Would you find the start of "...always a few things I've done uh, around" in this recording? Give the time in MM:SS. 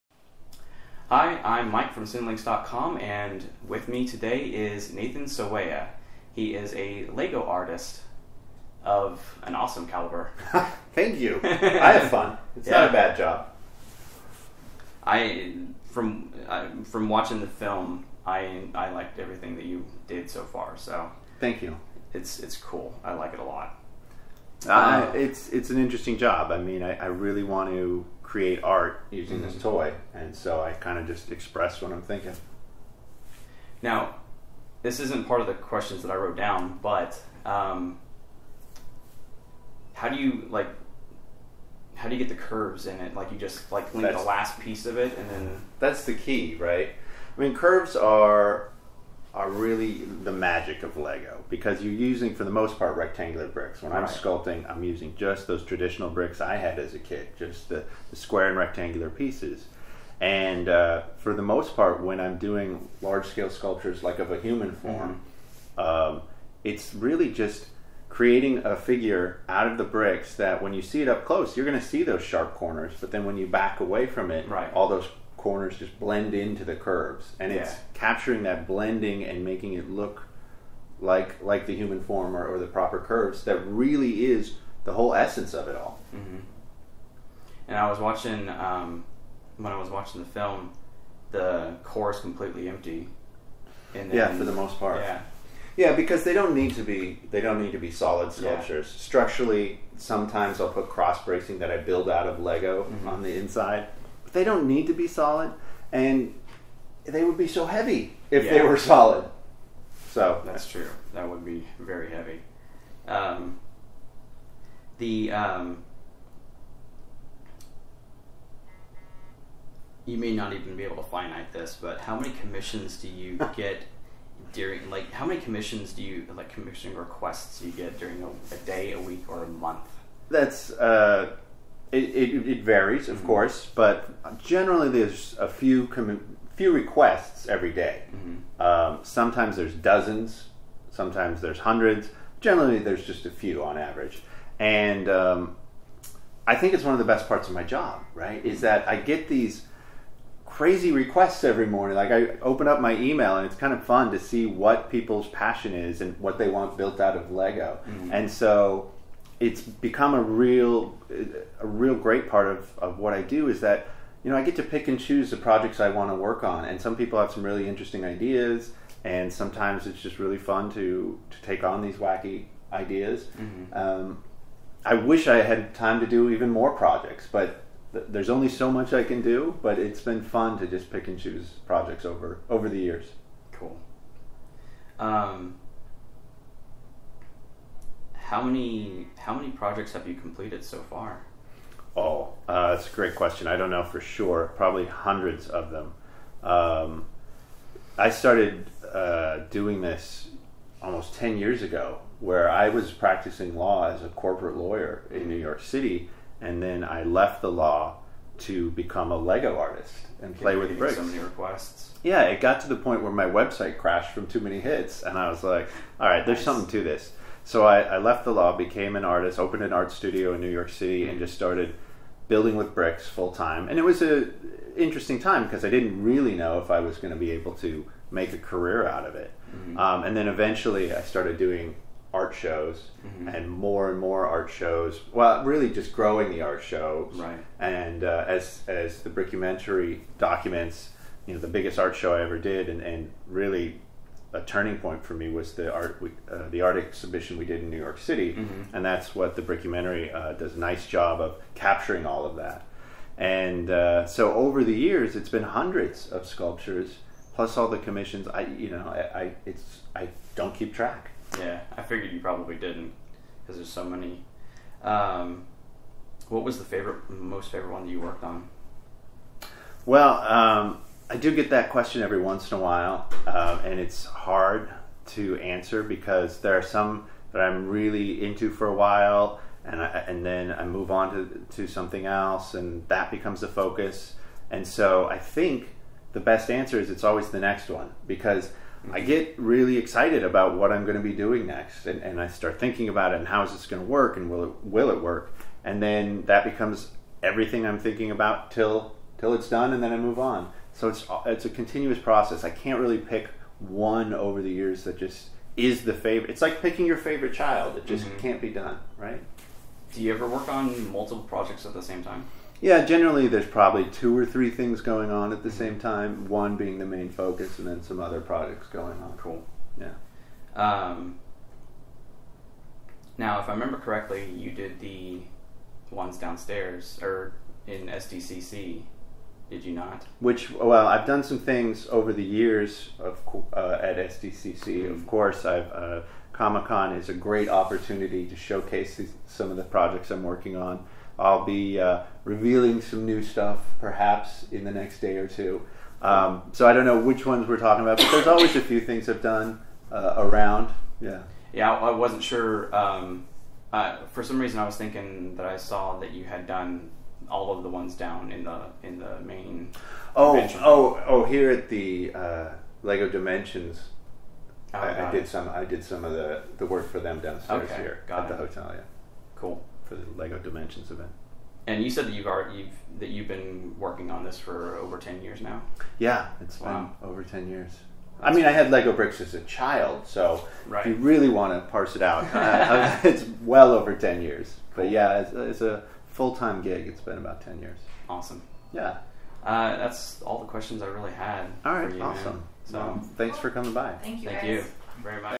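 05:48.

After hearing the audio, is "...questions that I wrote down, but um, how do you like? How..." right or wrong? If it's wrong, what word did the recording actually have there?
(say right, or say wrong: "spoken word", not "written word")
right.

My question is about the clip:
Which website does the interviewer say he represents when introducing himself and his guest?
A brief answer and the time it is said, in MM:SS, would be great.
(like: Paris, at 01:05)
Cinelinx.com, at 00:02.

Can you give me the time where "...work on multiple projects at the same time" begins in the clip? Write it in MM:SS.
05:10.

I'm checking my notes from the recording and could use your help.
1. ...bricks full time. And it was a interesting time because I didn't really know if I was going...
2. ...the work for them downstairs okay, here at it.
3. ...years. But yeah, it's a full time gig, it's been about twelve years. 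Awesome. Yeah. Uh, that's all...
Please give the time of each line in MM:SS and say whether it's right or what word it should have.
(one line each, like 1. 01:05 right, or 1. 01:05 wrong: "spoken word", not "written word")
1. 03:42 right
2. 06:06 right
3. 06:24 wrong: "ten", not "twelve".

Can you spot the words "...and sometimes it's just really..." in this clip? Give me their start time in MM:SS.
02:49.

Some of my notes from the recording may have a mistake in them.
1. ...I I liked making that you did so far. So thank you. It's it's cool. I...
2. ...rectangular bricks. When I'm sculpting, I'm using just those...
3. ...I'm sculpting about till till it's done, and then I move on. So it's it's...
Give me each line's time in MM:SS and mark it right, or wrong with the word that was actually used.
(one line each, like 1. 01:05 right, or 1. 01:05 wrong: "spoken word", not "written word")
1. 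00:18 wrong: "everything", not "making"
2. 00:52 right
3. 04:57 wrong: "thinking", not "sculpting".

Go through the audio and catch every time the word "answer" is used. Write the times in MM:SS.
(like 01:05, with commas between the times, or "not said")
04:35, 04:46.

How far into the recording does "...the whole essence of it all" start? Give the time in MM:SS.
01:24.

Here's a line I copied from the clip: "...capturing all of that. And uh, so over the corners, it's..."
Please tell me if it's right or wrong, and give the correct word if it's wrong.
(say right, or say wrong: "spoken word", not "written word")
wrong: "years", not "corners".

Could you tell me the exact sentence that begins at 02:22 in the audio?
Generally, there's just a few on average, and um, I think it's one of the best parts of my job.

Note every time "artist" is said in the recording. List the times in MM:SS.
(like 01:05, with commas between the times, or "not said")
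00:07, 03:29, 03:39.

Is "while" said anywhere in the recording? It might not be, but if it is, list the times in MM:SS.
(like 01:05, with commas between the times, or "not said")
04:32, 04:38.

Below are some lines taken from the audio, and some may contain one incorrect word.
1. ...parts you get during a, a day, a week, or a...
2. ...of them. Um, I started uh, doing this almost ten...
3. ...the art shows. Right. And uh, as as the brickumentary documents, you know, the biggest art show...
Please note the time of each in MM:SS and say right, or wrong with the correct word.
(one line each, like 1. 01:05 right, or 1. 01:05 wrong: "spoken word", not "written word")
1. 02:06 wrong: "requests", not "parts"
2. 03:15 right
3. 03:56 right.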